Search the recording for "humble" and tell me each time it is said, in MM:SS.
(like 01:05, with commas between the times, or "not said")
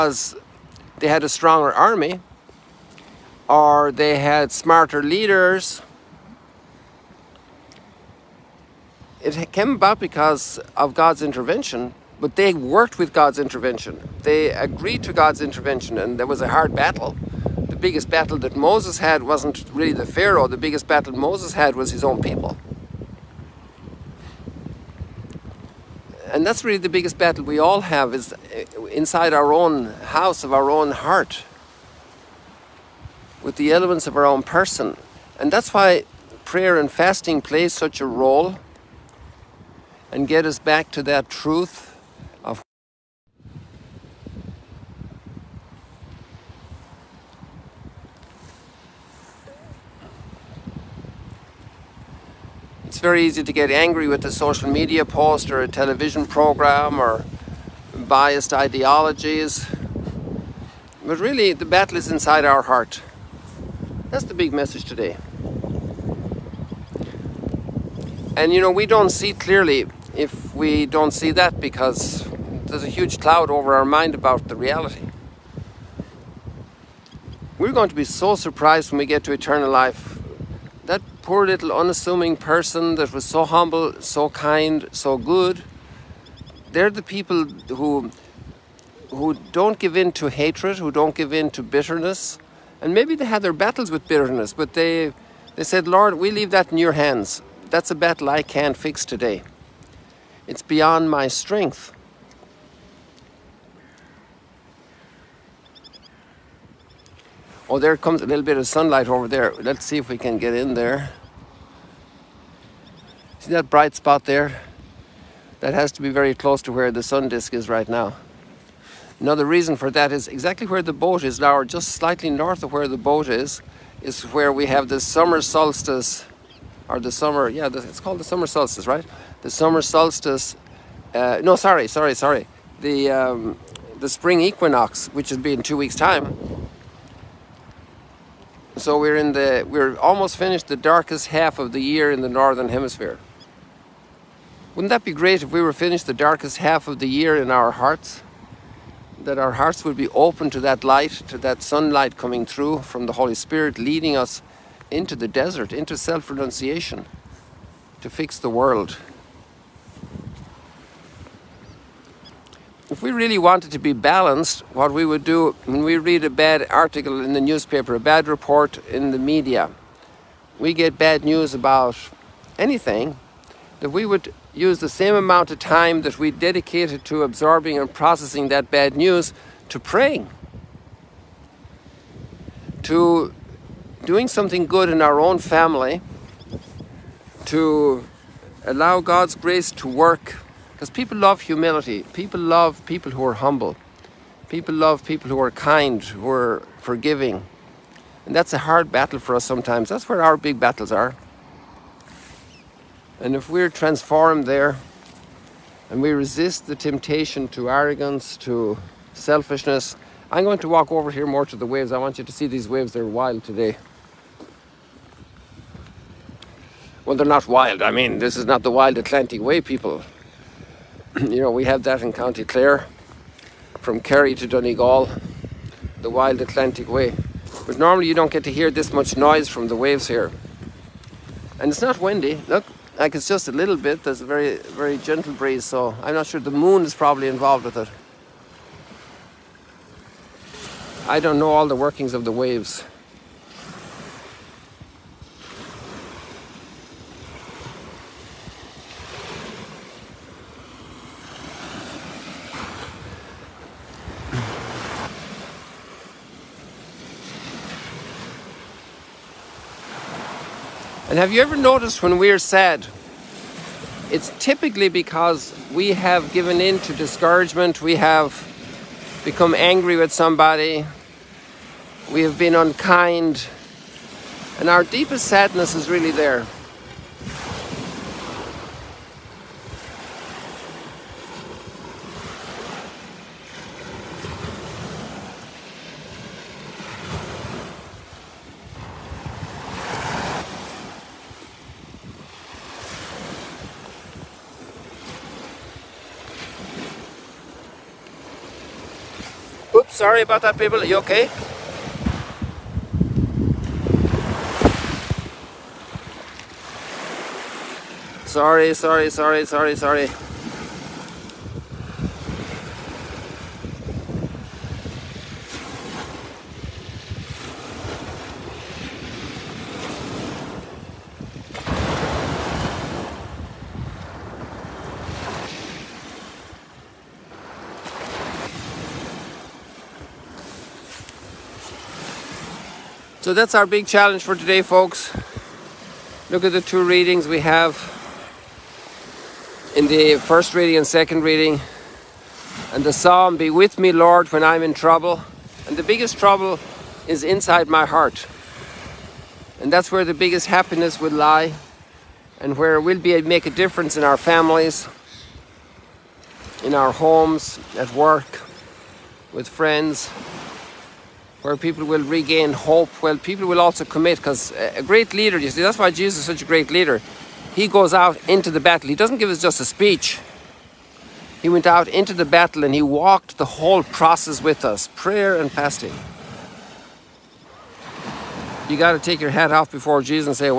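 01:23, 03:13.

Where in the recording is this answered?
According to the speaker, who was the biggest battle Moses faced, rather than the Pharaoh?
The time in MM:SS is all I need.
00:21.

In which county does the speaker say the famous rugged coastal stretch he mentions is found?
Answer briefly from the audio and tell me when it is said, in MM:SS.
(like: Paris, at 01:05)
County Clare, at 03:42.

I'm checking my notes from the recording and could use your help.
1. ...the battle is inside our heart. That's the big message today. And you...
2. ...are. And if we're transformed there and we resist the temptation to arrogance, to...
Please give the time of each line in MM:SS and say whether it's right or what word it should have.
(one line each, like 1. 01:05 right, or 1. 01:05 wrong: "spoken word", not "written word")
1. 01:01 right
2. 03:20 right.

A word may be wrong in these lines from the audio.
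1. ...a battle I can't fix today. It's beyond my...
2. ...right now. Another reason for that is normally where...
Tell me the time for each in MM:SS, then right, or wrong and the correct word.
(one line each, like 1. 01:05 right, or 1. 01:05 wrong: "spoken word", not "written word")
1. 01:37 right
2. 01:57 wrong: "exactly", not "normally".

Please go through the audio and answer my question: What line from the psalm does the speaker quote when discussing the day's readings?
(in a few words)
Be with me, Lord, when I'm in trouble.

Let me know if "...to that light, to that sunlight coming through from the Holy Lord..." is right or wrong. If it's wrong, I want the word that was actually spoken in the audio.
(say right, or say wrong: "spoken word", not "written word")
wrong: "Spirit", not "Lord".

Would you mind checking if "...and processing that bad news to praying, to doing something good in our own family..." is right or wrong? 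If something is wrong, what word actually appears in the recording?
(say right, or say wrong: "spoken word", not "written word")
right.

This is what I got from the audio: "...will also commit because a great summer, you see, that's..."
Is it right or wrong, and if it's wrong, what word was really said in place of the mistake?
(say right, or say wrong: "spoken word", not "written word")
wrong: "leader", not "summer".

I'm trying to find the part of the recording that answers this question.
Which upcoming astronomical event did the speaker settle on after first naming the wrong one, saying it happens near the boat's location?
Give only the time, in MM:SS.
02:14.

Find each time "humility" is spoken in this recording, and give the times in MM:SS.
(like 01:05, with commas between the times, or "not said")
03:11.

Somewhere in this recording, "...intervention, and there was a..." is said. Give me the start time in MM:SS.
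00:15.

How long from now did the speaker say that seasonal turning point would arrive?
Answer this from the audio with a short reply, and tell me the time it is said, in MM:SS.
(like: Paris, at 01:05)
2 weeks, at 02:15.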